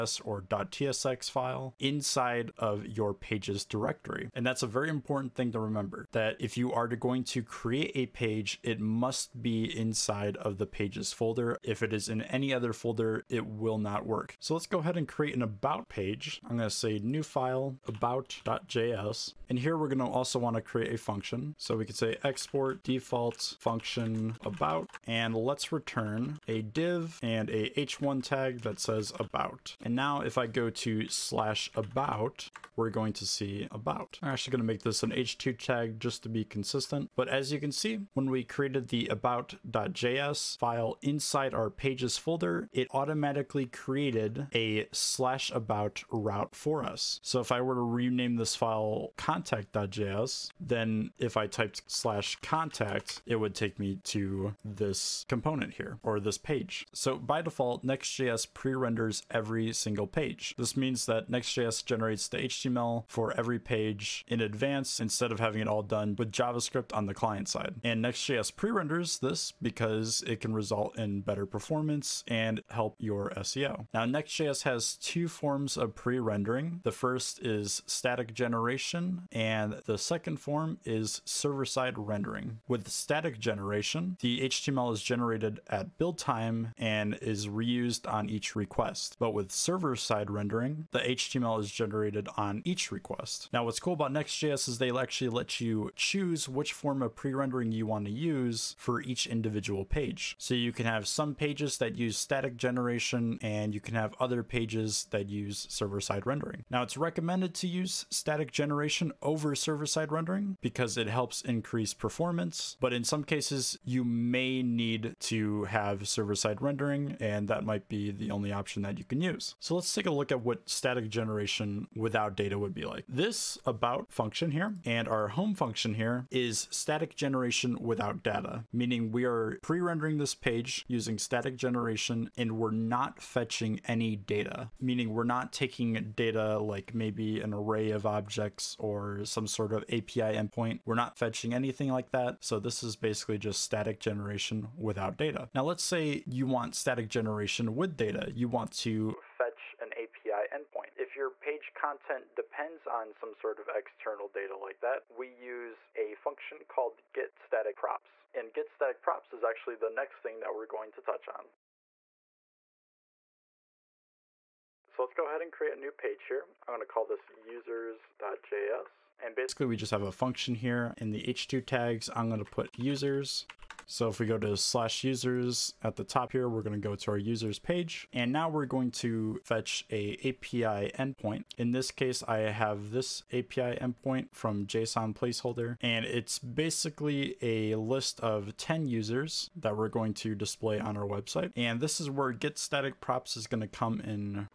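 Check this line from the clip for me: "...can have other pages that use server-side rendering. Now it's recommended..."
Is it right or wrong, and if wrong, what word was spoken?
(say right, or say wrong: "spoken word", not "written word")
right.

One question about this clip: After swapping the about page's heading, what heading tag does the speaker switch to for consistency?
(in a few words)
h2.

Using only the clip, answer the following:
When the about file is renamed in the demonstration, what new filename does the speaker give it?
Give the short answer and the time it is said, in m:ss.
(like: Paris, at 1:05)
contact.js, at 0:49.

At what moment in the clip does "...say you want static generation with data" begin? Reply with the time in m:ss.
2:25.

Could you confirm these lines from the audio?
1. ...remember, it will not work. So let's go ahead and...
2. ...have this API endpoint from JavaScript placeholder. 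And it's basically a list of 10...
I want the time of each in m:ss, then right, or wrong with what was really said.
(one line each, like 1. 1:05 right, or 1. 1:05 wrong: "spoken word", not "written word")
1. 0:12 wrong: "folder", not "remember"
2. 3:02 wrong: "JSON", not "JavaScript".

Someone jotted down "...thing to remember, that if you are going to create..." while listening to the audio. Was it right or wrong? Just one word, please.
right.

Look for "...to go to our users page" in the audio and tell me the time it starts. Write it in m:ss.
2:56.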